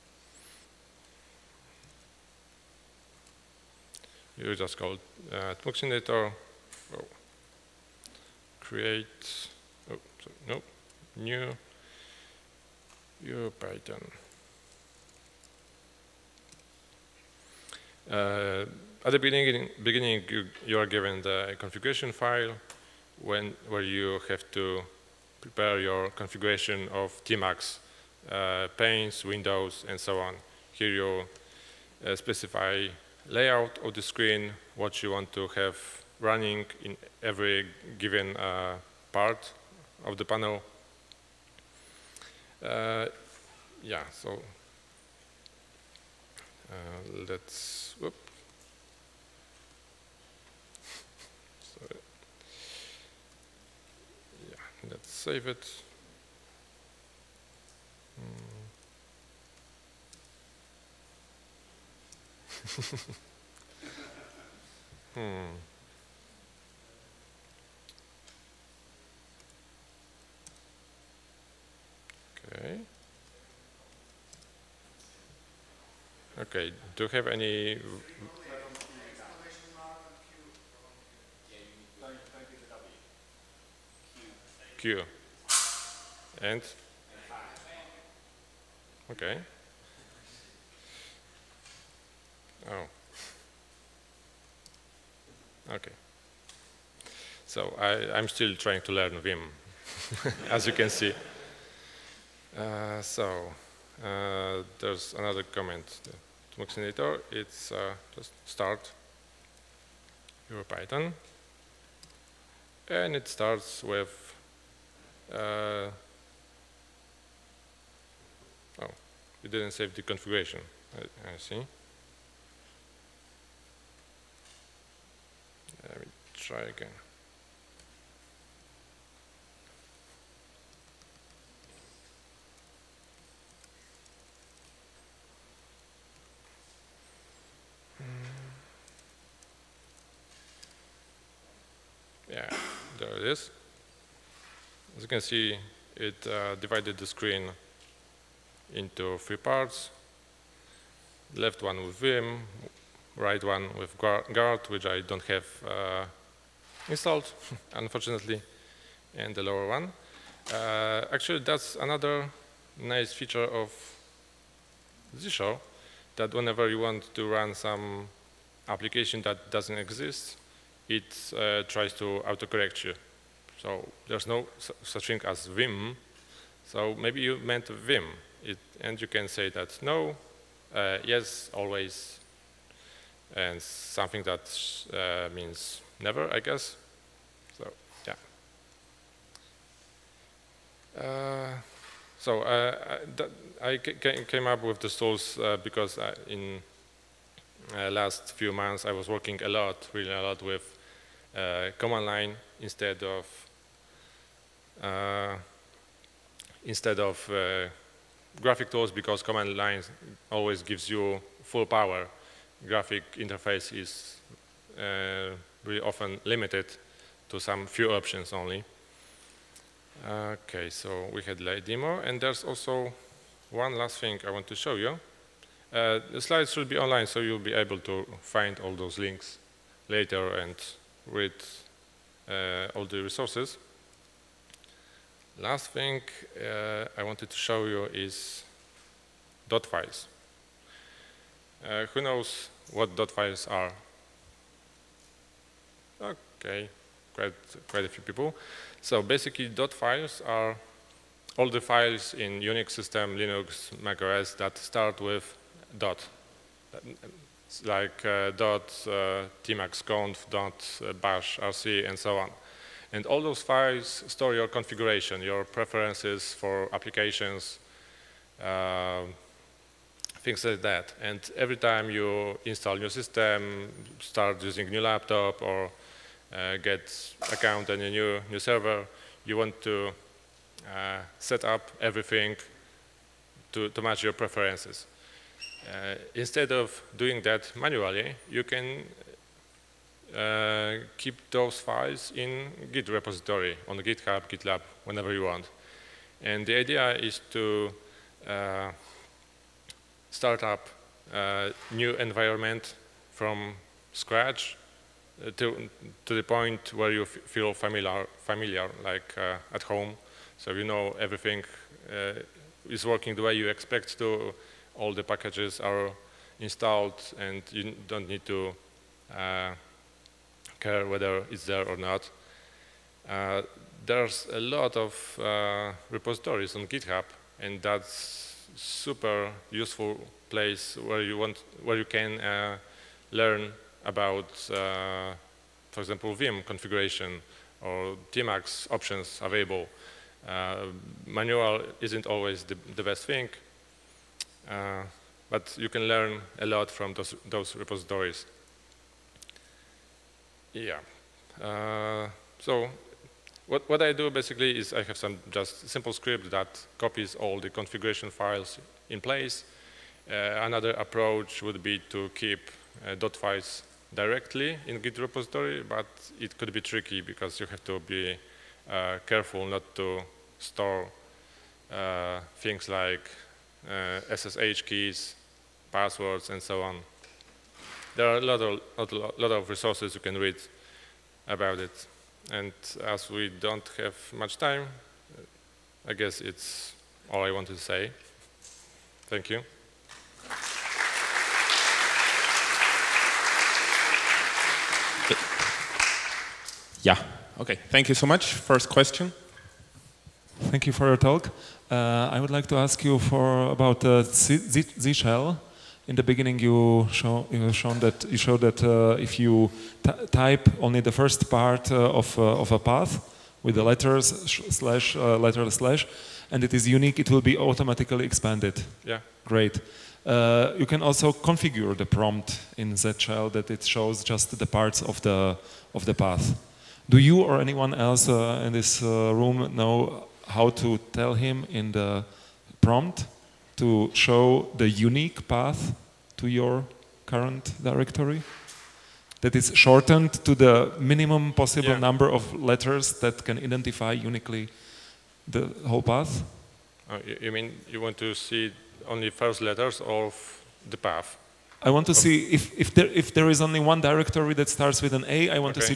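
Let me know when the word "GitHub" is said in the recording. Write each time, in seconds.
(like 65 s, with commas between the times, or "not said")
293 s, 326 s.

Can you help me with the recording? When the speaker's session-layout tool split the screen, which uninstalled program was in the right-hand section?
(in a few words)
guard.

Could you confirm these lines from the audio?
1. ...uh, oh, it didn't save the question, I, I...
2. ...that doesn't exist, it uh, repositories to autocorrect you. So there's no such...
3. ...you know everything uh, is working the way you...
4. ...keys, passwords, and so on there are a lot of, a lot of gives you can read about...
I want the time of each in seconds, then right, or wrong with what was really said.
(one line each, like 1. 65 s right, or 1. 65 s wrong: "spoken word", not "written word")
1. 115 s wrong: "configuration", not "question"
2. 169 s wrong: "tries", not "repositories"
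3. 310 s right
4. 374 s wrong: "resources", not "gives".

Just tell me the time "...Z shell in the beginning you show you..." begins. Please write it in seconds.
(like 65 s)
404 s.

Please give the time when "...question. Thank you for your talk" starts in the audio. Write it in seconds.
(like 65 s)
398 s.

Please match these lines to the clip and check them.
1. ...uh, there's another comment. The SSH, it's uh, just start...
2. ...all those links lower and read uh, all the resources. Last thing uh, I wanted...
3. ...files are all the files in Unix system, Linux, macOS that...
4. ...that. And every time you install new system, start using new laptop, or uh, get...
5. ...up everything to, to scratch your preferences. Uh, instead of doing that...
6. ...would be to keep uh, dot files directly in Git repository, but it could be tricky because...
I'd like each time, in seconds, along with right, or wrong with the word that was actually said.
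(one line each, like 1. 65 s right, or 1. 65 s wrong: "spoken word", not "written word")
1. 104 s wrong: "Tmuxinator", not "SSH"
2. 228 s wrong: "later", not "lower"
3. 249 s right
4. 270 s right
5. 281 s wrong: "match", not "scratch"
6. 361 s right.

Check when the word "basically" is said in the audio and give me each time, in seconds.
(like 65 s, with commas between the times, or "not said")
249 s, 354 s.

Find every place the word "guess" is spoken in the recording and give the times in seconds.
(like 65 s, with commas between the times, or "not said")
186 s, 385 s.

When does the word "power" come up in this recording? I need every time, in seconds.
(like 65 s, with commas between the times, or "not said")
211 s.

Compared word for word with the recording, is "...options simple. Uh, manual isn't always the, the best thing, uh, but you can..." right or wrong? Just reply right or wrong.
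wrong.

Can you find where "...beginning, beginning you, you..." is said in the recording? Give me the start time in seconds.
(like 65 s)
19 s.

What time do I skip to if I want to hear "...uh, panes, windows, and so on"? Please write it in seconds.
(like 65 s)
28 s.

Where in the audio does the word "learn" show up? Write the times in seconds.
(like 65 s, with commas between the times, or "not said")
98 s, 333 s, 345 s.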